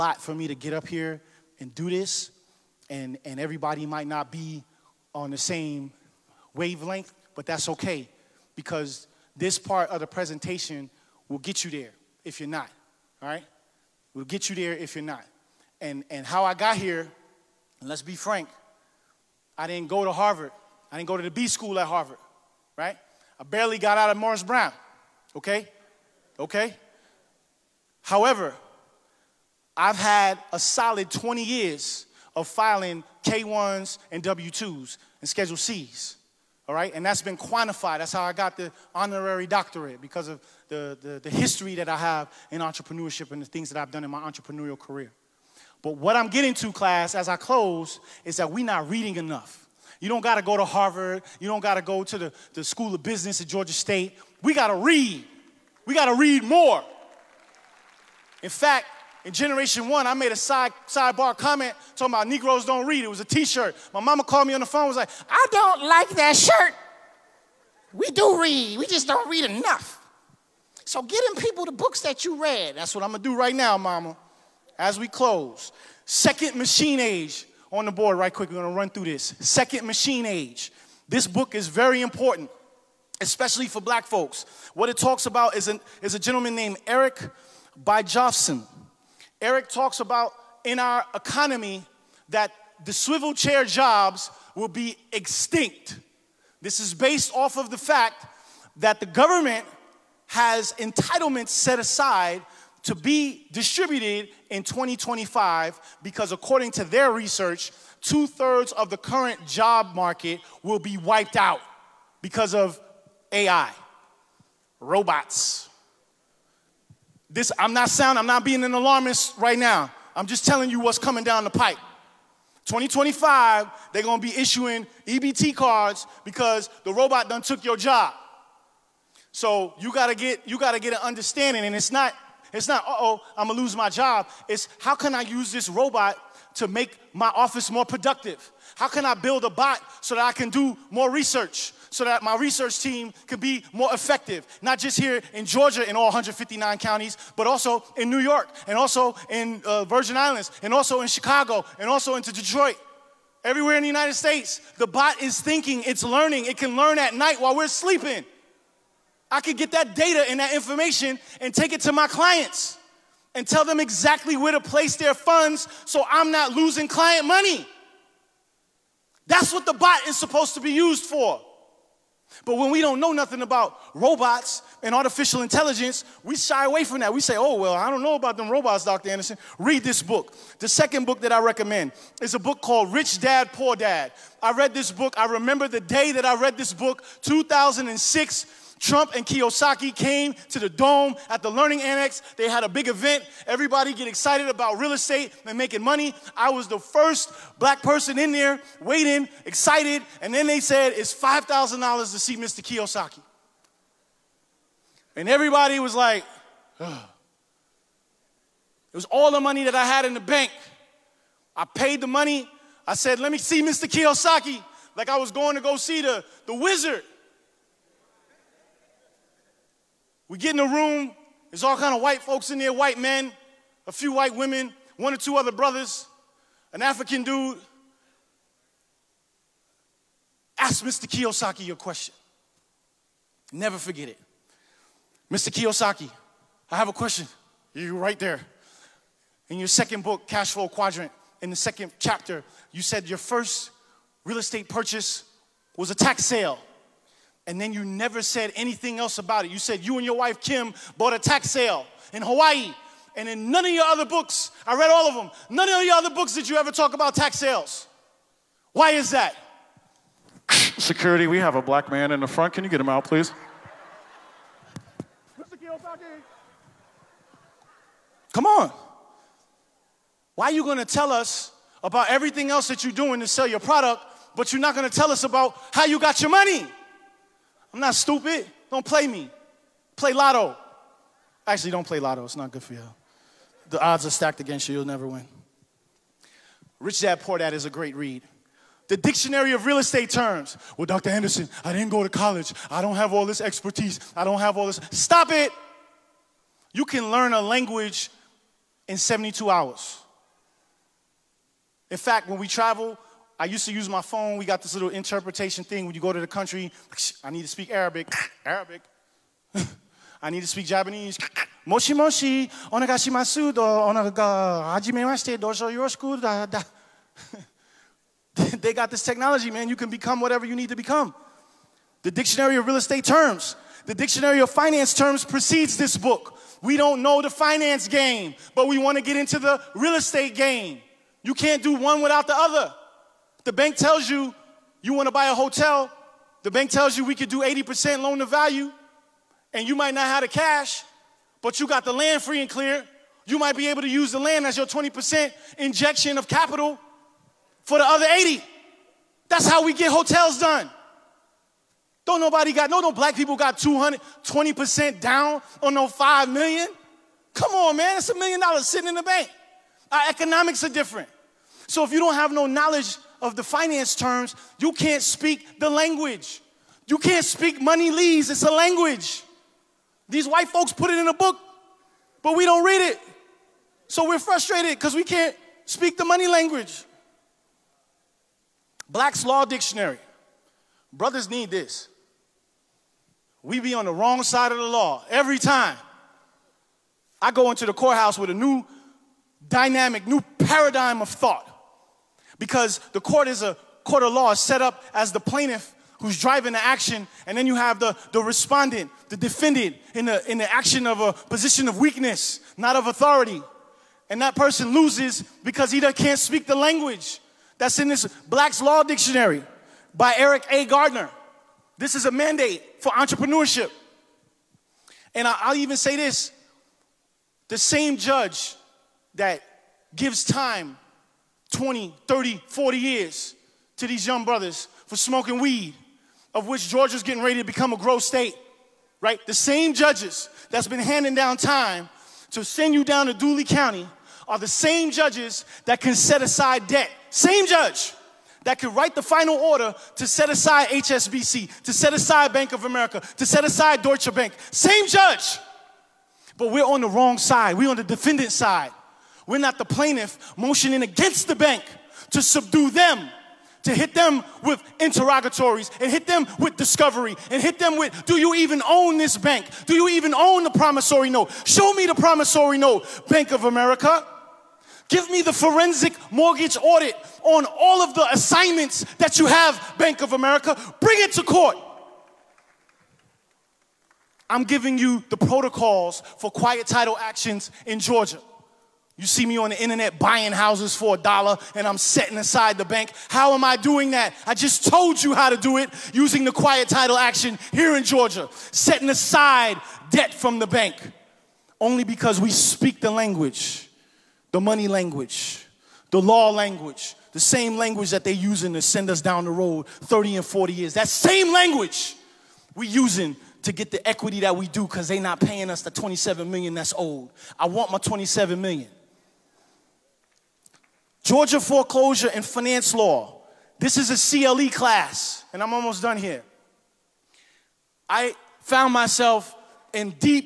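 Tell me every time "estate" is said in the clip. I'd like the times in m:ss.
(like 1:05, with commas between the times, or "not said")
3:14, 4:04, 4:49, 5:22, 5:29.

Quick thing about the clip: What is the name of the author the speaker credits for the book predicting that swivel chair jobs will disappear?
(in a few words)
Eric Brynjolfsson.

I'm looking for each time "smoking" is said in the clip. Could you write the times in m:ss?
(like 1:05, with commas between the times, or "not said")
7:04.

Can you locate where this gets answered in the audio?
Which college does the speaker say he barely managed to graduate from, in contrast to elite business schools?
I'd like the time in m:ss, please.
0:24.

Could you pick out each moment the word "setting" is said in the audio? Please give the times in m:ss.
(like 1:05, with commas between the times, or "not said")
8:01, 8:08.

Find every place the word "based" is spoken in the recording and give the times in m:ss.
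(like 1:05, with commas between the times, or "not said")
1:36.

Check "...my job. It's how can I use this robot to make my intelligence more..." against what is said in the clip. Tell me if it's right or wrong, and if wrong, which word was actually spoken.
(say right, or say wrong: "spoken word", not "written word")
wrong: "office", not "intelligence".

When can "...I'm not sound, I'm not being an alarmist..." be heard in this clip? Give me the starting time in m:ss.
1:57.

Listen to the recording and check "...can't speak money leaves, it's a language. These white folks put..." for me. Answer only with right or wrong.
right.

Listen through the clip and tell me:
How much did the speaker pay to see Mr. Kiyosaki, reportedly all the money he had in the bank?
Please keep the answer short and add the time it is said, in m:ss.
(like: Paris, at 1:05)
$5,000, at 3:21.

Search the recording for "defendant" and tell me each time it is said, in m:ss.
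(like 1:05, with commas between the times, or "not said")
6:39, 7:27.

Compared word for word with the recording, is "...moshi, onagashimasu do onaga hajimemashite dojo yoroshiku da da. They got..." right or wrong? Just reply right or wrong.
right.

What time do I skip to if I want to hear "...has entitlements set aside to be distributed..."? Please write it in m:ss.
1:40.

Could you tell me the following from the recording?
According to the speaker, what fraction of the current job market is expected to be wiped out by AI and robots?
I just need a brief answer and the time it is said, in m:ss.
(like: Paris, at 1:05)
two thirds, at 1:48.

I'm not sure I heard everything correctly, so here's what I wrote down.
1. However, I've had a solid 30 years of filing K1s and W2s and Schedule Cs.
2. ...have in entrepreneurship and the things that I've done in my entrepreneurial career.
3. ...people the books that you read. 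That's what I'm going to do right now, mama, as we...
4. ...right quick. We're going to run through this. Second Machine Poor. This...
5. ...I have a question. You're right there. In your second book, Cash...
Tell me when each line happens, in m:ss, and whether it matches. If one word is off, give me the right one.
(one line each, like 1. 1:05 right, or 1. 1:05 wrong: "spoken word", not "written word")
1. 0:28 wrong: "20", not "30"
2. 0:41 right
3. 1:11 right
4. 1:18 wrong: "Age", not "Poor"
5. 3:56 right.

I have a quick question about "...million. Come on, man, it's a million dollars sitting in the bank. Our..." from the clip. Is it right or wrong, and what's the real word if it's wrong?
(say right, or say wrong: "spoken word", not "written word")
right.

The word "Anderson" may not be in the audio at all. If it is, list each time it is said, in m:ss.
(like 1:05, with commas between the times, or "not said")
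2:59, 4:51.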